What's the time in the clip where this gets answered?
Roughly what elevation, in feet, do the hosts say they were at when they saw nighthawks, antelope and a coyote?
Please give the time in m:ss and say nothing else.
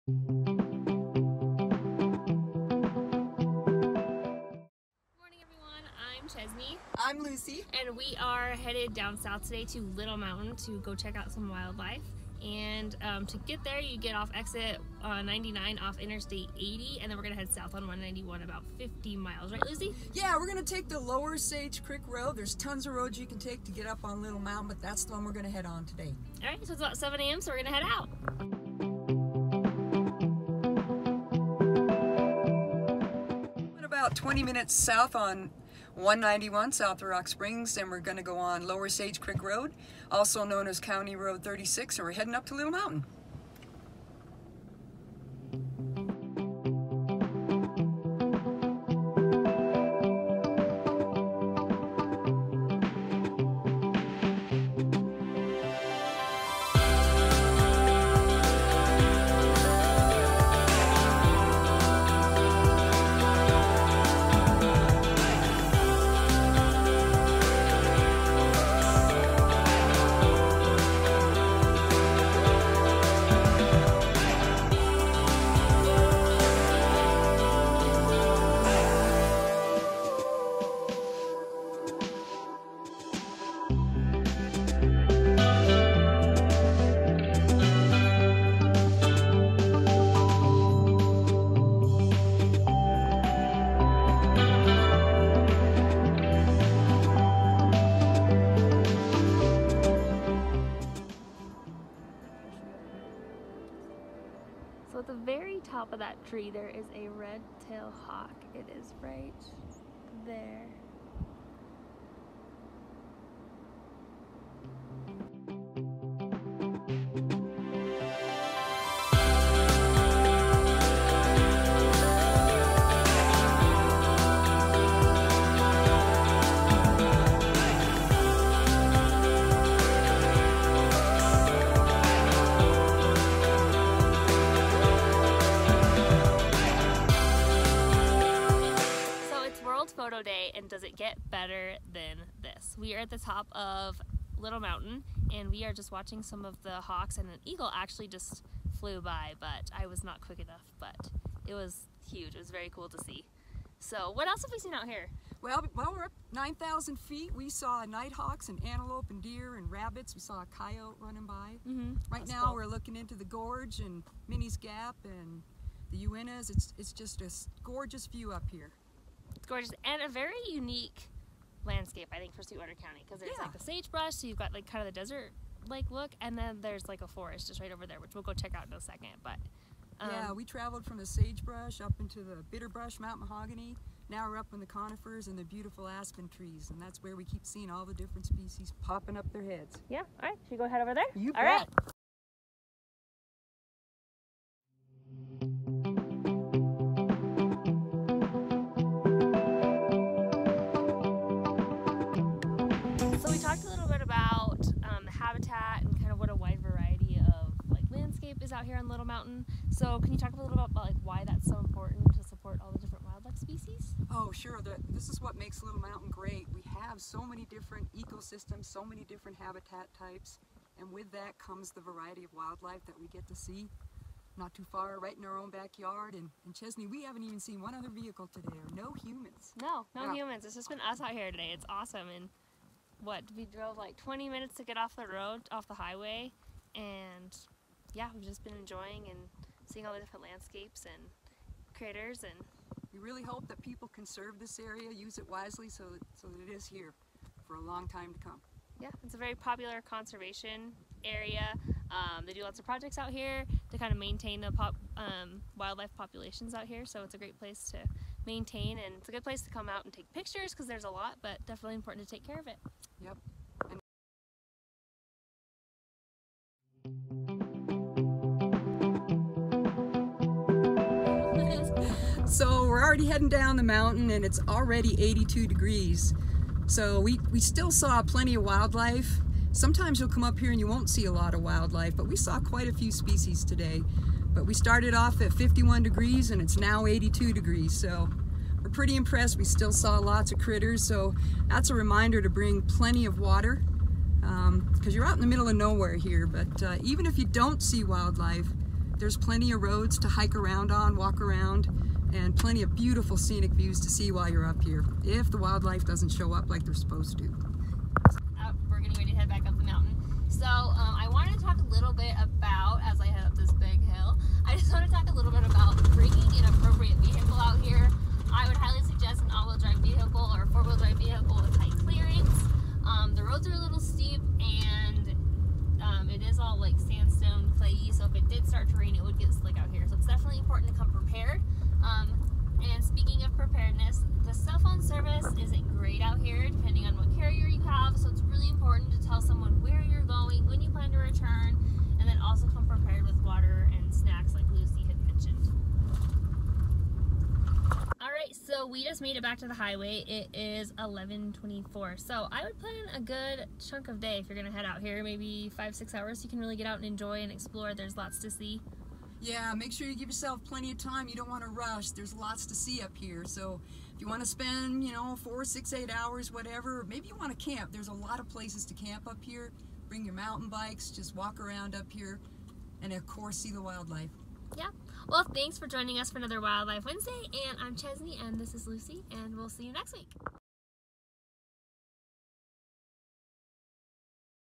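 2:36.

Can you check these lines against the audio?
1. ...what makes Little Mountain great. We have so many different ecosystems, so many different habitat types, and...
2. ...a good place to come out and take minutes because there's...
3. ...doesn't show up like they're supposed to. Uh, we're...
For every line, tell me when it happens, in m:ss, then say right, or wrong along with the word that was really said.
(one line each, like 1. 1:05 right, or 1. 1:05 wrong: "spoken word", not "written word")
1. 3:35 right
2. 4:19 wrong: "pictures", not "minutes"
3. 5:05 right.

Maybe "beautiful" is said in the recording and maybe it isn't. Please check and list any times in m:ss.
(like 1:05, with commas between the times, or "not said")
3:05, 5:02.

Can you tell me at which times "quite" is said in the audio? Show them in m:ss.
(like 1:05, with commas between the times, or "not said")
4:42.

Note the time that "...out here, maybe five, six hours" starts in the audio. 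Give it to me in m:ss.
5:54.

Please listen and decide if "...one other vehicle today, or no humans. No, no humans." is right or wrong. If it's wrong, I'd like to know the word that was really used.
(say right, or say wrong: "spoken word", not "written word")
right.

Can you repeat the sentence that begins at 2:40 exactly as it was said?
We saw a coyote running by.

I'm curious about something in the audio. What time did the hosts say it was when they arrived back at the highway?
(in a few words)
11:24.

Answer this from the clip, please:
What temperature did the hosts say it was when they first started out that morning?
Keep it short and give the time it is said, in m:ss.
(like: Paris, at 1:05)
51 degrees, at 4:45.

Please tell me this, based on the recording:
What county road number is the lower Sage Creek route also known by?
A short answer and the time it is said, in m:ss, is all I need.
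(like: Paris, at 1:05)
36, at 0:40.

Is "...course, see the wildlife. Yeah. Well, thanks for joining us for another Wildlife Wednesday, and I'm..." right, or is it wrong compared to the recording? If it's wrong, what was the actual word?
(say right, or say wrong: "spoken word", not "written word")
right.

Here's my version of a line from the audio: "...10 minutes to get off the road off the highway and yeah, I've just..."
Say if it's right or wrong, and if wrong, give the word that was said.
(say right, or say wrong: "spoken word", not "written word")
wrong: "20", not "10".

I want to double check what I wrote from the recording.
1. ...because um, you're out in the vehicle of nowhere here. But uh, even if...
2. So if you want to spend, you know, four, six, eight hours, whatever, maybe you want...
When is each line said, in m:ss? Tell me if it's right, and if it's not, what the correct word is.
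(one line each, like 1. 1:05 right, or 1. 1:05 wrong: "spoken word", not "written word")
1. 4:54 wrong: "middle", not "vehicle"
2. 6:03 right.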